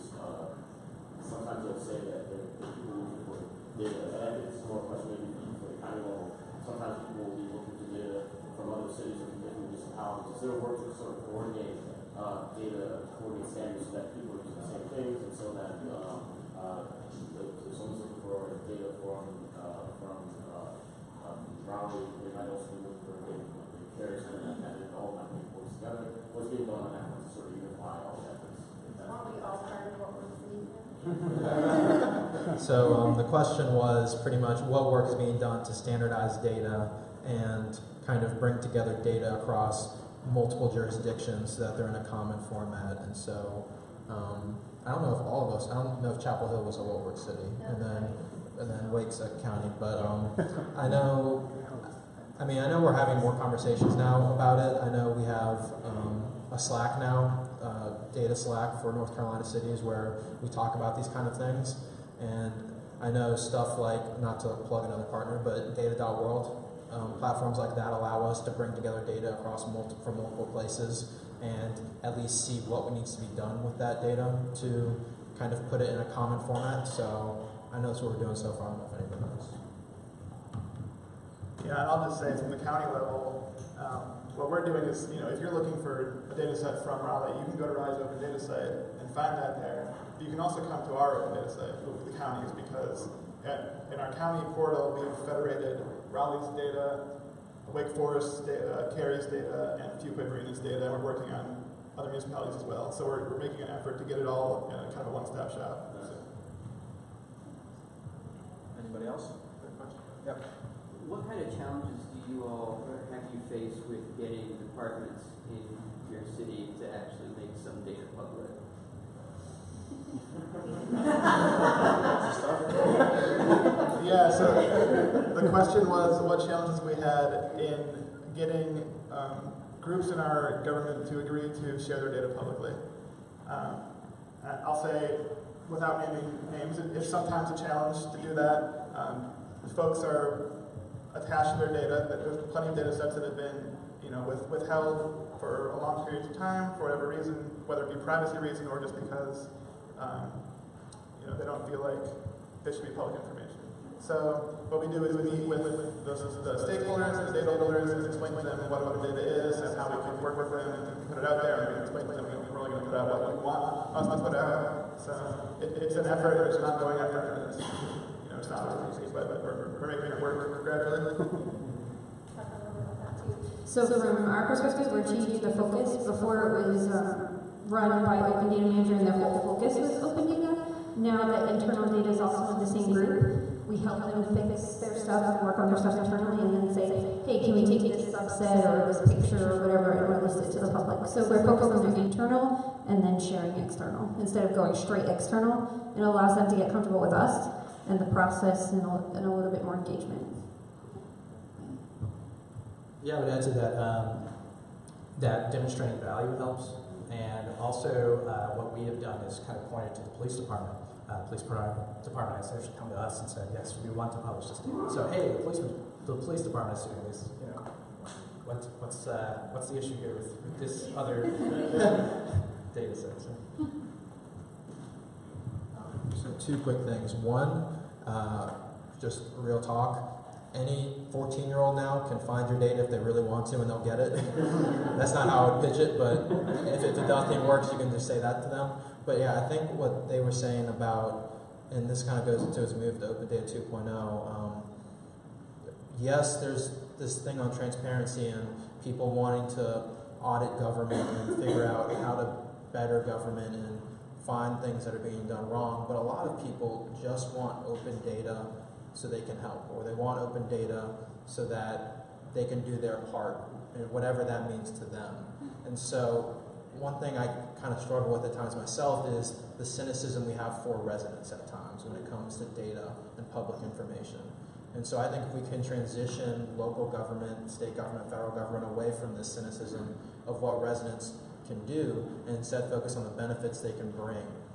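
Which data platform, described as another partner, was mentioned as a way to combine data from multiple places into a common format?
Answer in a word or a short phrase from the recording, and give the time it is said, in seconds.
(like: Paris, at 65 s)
data.world, at 65 s.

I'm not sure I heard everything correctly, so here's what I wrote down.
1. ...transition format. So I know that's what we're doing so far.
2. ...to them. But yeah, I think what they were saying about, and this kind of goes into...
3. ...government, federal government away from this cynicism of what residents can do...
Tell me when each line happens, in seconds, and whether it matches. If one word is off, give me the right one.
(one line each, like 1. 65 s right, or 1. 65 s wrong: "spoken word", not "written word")
1. 76 s wrong: "common", not "transition"
2. 238 s right
3. 277 s right.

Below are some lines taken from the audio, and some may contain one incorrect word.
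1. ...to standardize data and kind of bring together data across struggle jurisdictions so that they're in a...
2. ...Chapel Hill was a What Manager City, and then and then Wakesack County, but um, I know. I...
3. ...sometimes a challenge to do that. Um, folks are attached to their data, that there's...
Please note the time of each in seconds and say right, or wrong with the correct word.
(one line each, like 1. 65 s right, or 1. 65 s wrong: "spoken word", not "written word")
1. 35 s wrong: "multiple", not "struggle"
2. 46 s wrong: "Works", not "Manager"
3. 137 s right.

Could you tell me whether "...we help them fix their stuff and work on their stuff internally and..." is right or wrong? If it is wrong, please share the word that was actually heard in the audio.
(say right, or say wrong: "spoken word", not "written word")
right.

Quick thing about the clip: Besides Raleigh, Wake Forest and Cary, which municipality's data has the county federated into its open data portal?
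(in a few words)
Fuquay-Varina.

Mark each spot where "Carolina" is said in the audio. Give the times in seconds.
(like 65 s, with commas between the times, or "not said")
59 s.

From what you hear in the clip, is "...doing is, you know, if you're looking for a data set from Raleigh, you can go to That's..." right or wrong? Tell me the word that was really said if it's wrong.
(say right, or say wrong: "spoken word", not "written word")
wrong: "Raleigh", not "That".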